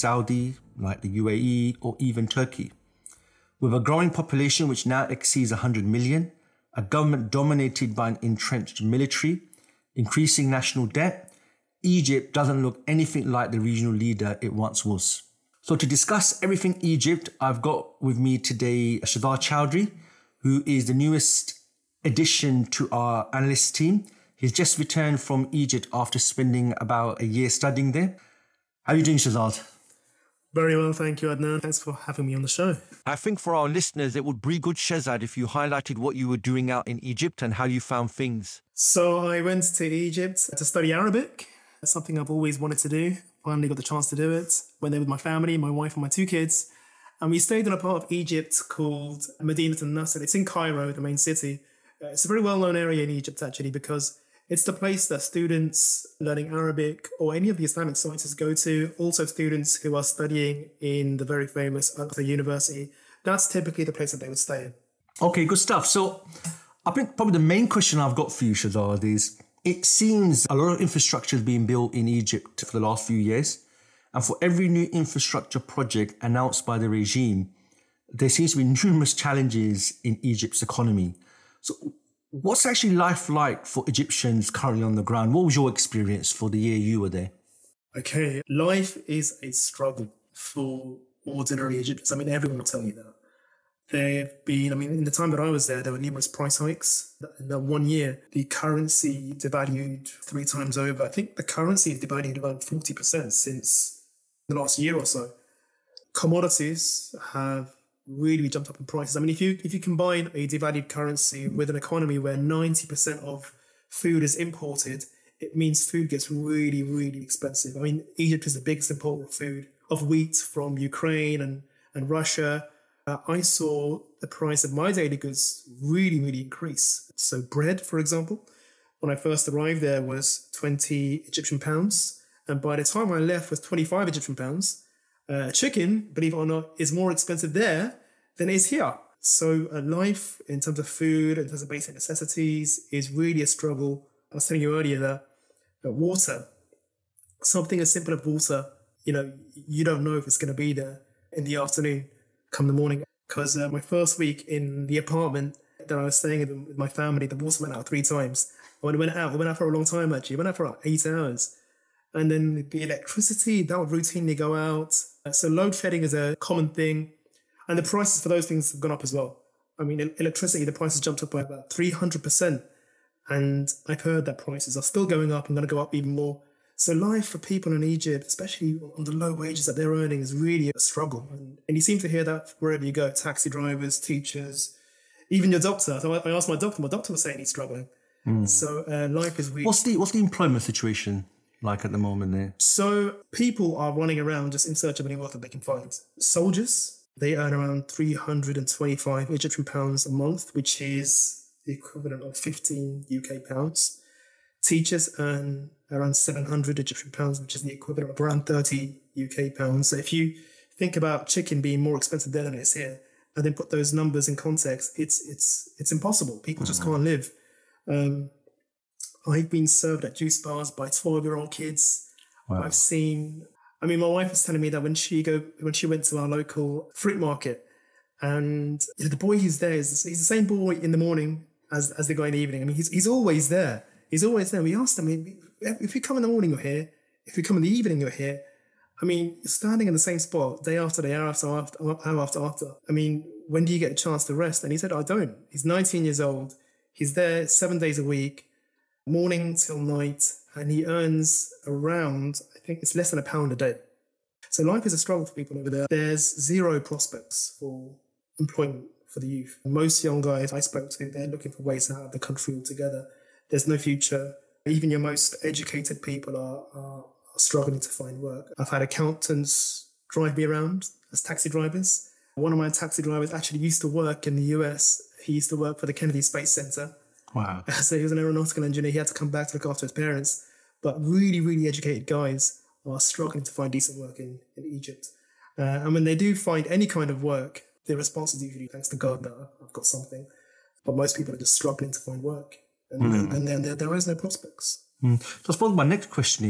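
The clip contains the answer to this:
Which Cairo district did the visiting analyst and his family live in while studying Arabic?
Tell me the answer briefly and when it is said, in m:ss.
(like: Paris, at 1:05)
Madinat Nasr, at 0:49.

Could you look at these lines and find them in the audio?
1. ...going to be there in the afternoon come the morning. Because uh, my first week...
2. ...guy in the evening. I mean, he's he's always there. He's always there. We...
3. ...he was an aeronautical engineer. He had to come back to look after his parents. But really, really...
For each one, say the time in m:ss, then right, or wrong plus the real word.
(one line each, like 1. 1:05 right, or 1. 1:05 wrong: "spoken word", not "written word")
1. 2:30 right
2. 3:52 right
3. 4:37 right.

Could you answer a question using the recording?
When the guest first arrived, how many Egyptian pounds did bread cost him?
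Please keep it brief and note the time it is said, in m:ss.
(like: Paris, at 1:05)
20 Egyptian pounds, at 2:10.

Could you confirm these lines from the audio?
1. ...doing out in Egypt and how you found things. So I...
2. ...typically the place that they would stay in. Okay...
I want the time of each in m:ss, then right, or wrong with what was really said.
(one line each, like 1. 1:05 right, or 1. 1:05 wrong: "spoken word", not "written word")
1. 0:36 right
2. 1:03 right.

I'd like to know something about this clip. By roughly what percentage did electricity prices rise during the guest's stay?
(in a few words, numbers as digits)
300%.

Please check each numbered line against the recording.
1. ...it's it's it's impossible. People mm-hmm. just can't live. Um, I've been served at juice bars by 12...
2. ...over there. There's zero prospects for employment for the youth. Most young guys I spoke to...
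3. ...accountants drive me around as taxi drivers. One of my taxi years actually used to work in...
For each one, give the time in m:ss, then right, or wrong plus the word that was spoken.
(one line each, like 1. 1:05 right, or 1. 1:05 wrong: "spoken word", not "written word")
1. 3:34 right
2. 4:15 right
3. 4:28 wrong: "drivers", not "years".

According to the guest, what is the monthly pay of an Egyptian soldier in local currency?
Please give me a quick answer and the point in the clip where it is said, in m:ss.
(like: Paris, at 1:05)
325 Egyptian pounds, at 3:17.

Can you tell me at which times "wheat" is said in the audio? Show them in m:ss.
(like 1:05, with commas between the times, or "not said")
2:00.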